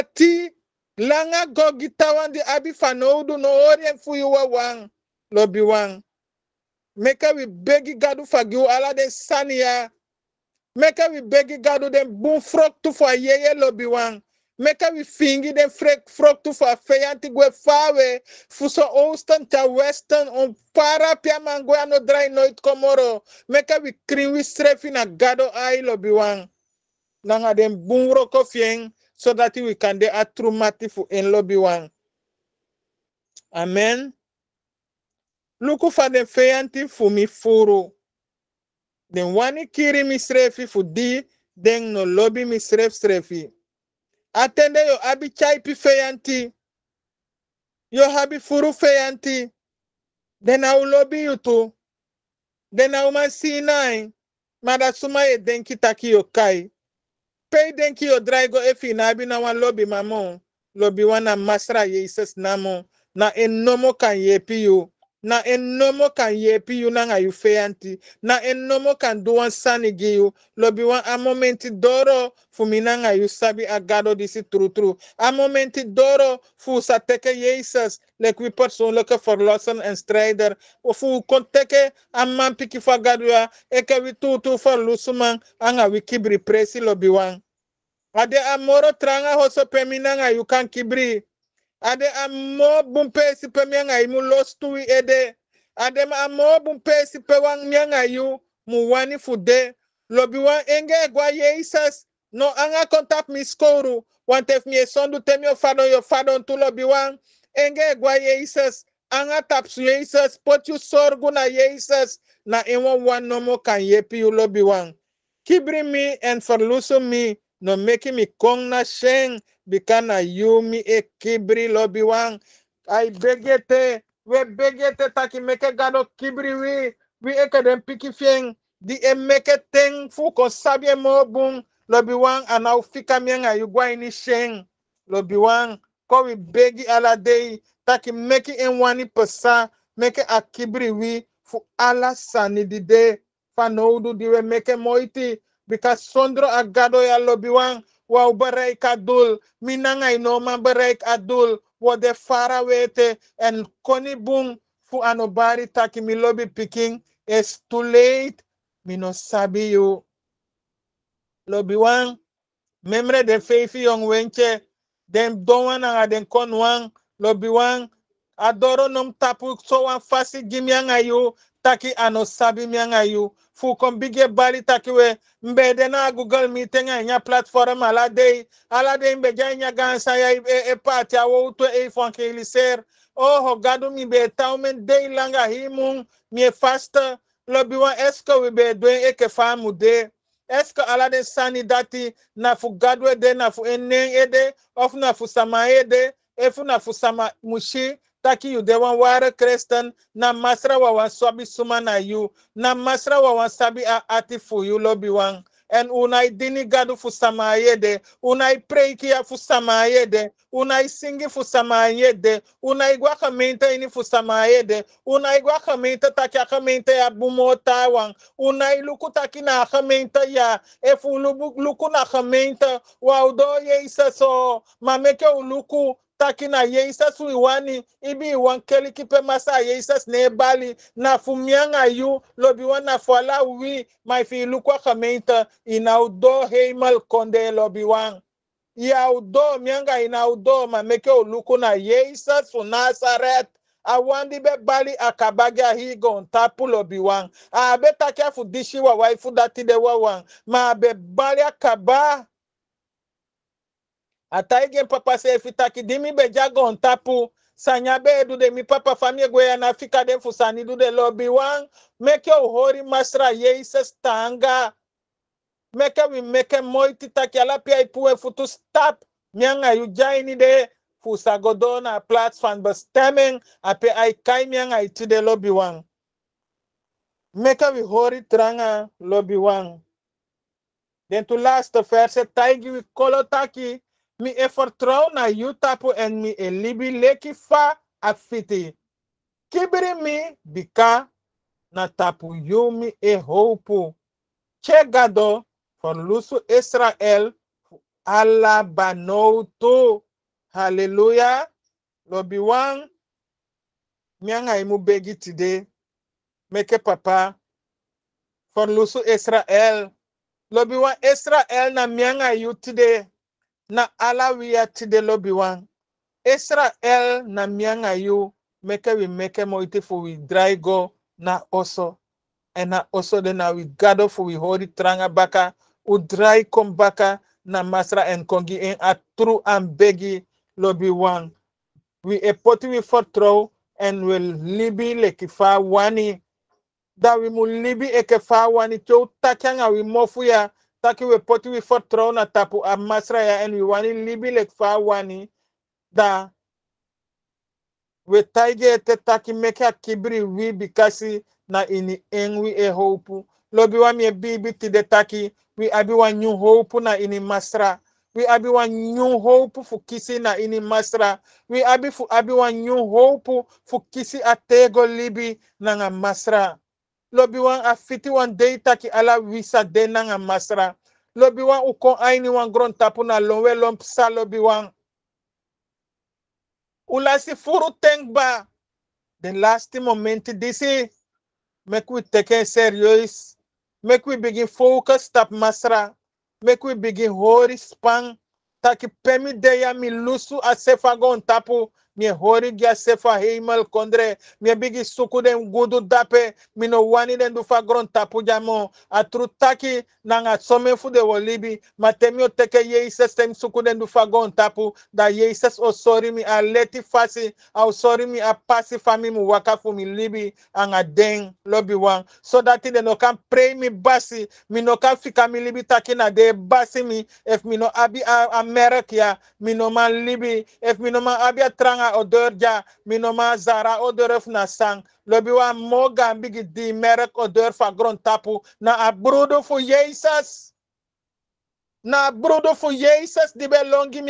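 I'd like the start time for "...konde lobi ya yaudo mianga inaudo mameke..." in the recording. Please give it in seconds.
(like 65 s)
236 s.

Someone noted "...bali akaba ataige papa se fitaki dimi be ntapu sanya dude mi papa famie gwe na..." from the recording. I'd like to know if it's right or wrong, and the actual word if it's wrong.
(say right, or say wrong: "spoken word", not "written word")
right.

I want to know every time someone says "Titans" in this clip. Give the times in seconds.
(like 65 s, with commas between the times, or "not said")
not said.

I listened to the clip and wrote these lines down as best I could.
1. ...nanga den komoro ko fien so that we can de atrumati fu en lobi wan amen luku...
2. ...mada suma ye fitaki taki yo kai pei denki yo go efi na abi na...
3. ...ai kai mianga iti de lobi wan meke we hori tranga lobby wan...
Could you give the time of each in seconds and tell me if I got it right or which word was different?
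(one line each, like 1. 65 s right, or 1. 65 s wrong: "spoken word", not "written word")
1. 27 s wrong: "bungro", not "komoro"
2. 54 s wrong: "denki", not "fitaki"
3. 273 s right.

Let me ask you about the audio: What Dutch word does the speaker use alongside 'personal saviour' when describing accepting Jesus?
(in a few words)
strijder.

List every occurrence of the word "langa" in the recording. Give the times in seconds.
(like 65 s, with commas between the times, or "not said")
0 s, 185 s.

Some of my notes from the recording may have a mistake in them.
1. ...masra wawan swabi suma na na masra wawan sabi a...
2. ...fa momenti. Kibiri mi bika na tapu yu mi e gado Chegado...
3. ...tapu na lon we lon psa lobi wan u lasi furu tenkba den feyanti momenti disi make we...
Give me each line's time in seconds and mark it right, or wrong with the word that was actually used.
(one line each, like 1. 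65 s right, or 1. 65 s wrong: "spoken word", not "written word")
1. 200 s right
2. 287 s wrong: "afiti", not "momenti"
3. 372 s wrong: "lasti", not "feyanti".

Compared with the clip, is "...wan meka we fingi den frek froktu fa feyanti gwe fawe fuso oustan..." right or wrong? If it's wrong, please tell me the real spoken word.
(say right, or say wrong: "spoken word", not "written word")
right.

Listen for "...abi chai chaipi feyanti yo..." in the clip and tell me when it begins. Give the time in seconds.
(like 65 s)
45 s.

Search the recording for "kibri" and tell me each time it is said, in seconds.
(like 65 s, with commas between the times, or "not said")
90 s, 115 s, 121 s, 126 s, 140 s, 349 s.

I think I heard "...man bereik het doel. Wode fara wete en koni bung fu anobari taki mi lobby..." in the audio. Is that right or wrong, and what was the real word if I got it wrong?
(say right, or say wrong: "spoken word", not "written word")
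right.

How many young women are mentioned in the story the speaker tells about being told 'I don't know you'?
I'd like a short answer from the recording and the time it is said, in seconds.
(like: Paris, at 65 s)
5, at 163 s.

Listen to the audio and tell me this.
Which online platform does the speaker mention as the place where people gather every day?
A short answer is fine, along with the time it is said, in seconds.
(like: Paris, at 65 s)
Google Meeting, at 176 s.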